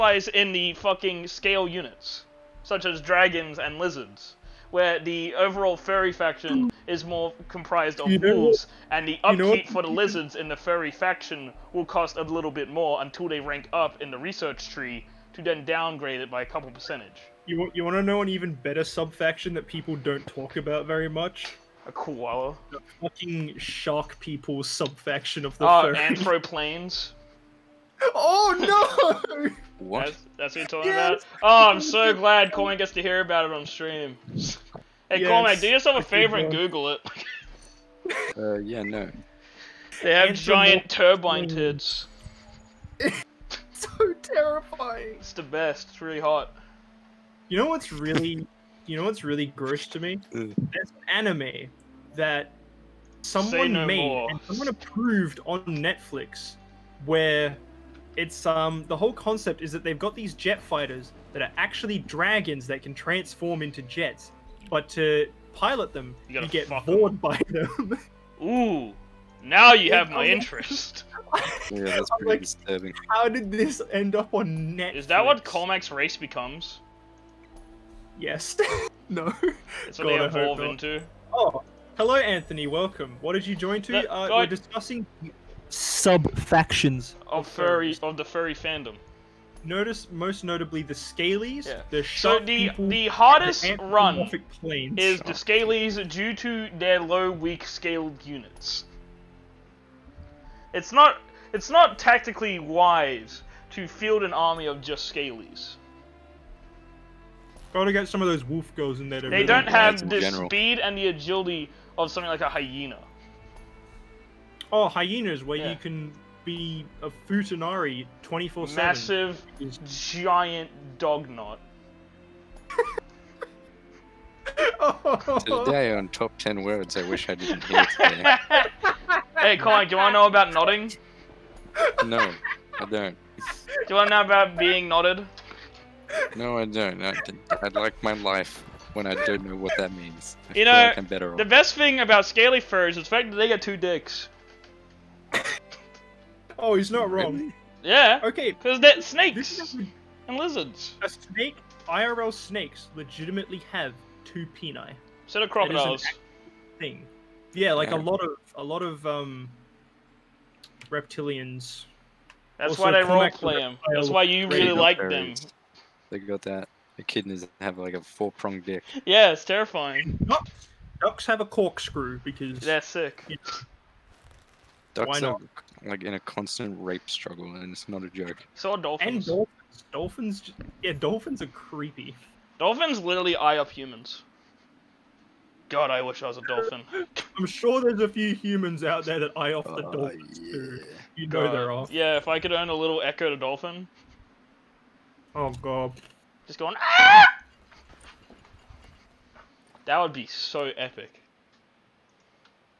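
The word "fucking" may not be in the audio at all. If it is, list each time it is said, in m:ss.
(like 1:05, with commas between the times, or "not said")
0:00, 0:23.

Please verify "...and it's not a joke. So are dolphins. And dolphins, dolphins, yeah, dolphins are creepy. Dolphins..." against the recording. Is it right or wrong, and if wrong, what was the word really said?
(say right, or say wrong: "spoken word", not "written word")
right.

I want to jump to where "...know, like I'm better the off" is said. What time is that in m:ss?
2:20.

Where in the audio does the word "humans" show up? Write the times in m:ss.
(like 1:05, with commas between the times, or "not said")
3:03, 3:08.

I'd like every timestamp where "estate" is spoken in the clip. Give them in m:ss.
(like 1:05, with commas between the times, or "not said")
not said.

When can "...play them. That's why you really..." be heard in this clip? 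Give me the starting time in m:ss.
2:43.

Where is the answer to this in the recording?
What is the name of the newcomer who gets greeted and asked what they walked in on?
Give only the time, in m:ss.
1:22.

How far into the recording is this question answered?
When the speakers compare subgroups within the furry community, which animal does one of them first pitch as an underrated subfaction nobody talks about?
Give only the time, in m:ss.
0:21.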